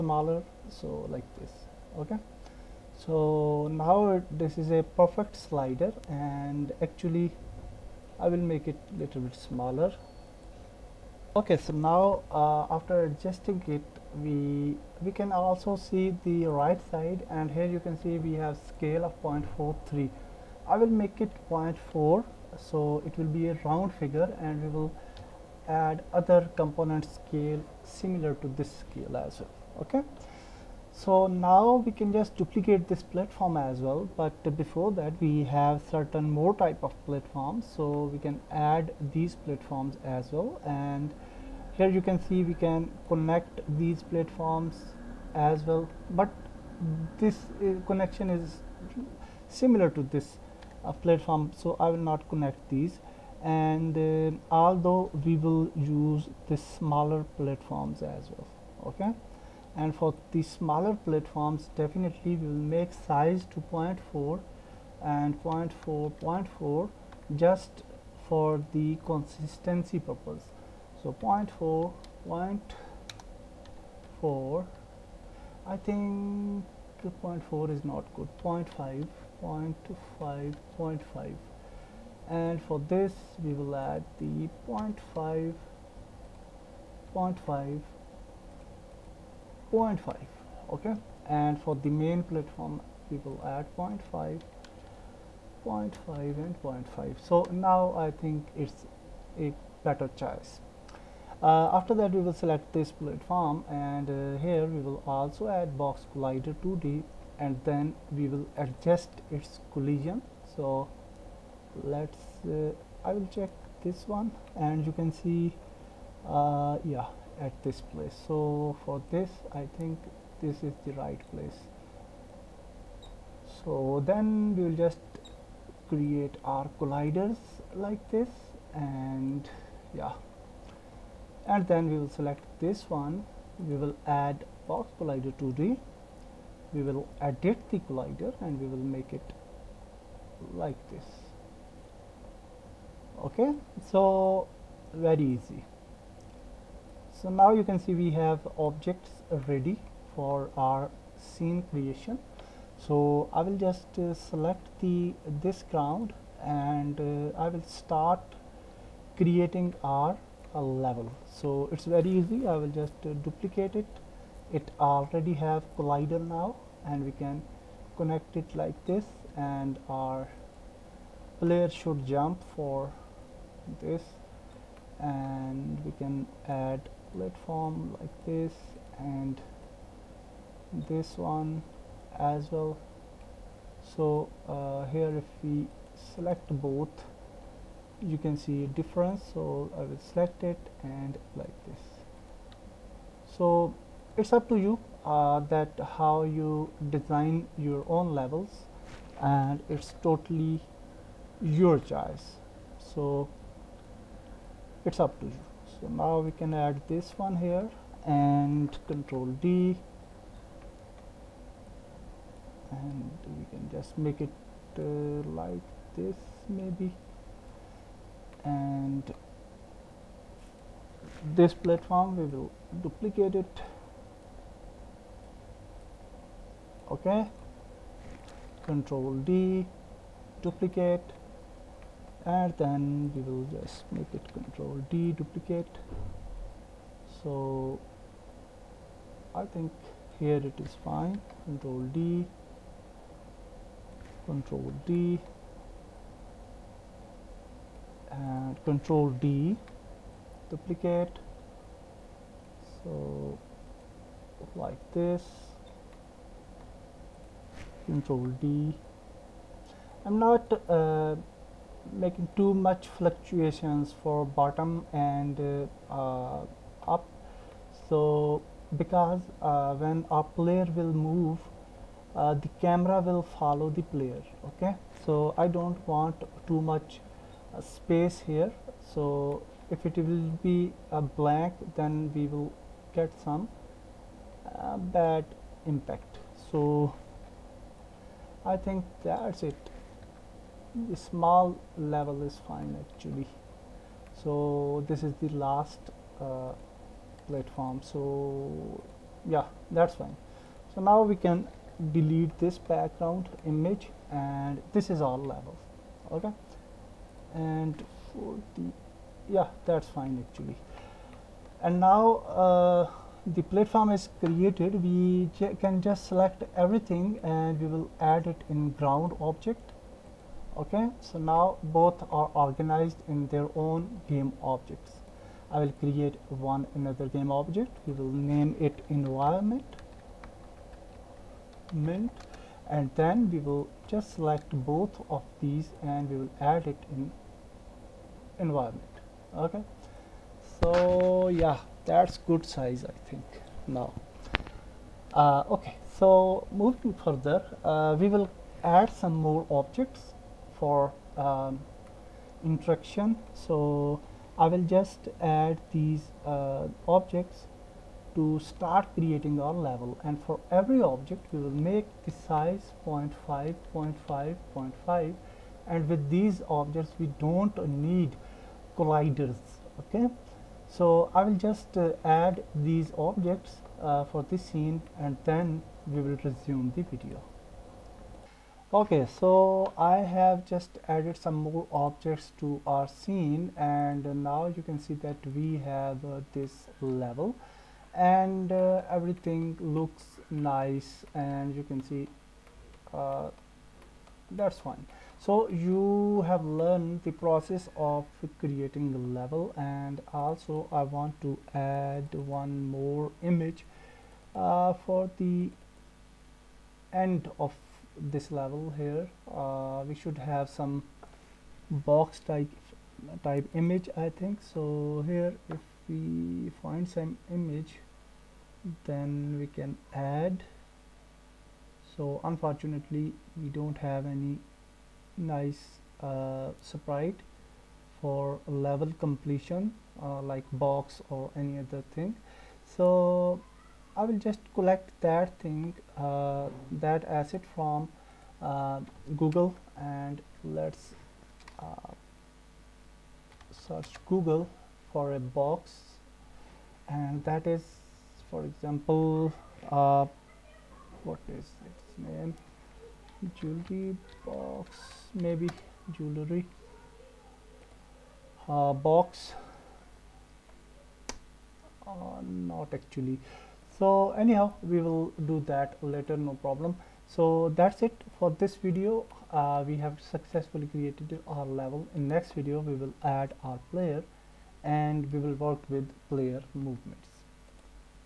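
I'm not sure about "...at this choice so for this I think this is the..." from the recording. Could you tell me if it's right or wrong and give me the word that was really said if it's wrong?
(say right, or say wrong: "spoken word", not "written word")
wrong: "place", not "choice".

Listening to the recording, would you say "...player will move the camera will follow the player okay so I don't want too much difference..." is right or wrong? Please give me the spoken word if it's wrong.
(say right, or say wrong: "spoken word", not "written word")
wrong: "space", not "difference".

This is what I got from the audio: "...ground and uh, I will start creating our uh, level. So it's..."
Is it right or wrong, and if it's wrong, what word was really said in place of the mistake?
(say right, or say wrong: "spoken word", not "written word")
right.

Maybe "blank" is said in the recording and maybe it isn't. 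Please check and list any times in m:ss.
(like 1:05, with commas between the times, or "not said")
4:41.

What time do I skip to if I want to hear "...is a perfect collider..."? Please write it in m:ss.
0:04.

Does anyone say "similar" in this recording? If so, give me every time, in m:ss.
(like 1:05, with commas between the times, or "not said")
0:27, 0:49.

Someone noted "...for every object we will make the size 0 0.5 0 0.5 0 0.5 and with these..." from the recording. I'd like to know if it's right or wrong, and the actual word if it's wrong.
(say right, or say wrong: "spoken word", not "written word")
right.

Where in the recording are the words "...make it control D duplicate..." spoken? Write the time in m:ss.
3:53.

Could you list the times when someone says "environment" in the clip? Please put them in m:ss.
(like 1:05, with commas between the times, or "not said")
5:28, 5:38.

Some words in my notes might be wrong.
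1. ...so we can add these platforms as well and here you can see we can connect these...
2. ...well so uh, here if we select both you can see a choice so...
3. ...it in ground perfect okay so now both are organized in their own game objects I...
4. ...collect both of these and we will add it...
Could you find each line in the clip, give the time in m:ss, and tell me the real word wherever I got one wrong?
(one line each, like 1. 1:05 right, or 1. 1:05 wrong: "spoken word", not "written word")
1. 0:37 right
2. 3:02 wrong: "difference", not "choice"
3. 5:18 wrong: "object", not "perfect"
4. 5:34 wrong: "select", not "collect".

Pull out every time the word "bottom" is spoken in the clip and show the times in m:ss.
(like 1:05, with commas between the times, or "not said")
4:24.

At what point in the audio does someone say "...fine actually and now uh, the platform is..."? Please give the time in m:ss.
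5:09.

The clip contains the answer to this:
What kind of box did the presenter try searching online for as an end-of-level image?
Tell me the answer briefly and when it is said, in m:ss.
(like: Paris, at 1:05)
jewelry box, at 7:33.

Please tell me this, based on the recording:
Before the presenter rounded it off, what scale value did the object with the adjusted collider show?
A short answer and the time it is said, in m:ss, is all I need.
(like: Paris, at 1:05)
0.43, at 0:19.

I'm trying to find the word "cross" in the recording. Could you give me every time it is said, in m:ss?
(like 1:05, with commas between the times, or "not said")
not said.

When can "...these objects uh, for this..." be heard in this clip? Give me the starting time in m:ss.
6:12.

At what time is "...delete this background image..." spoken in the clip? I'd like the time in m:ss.
5:01.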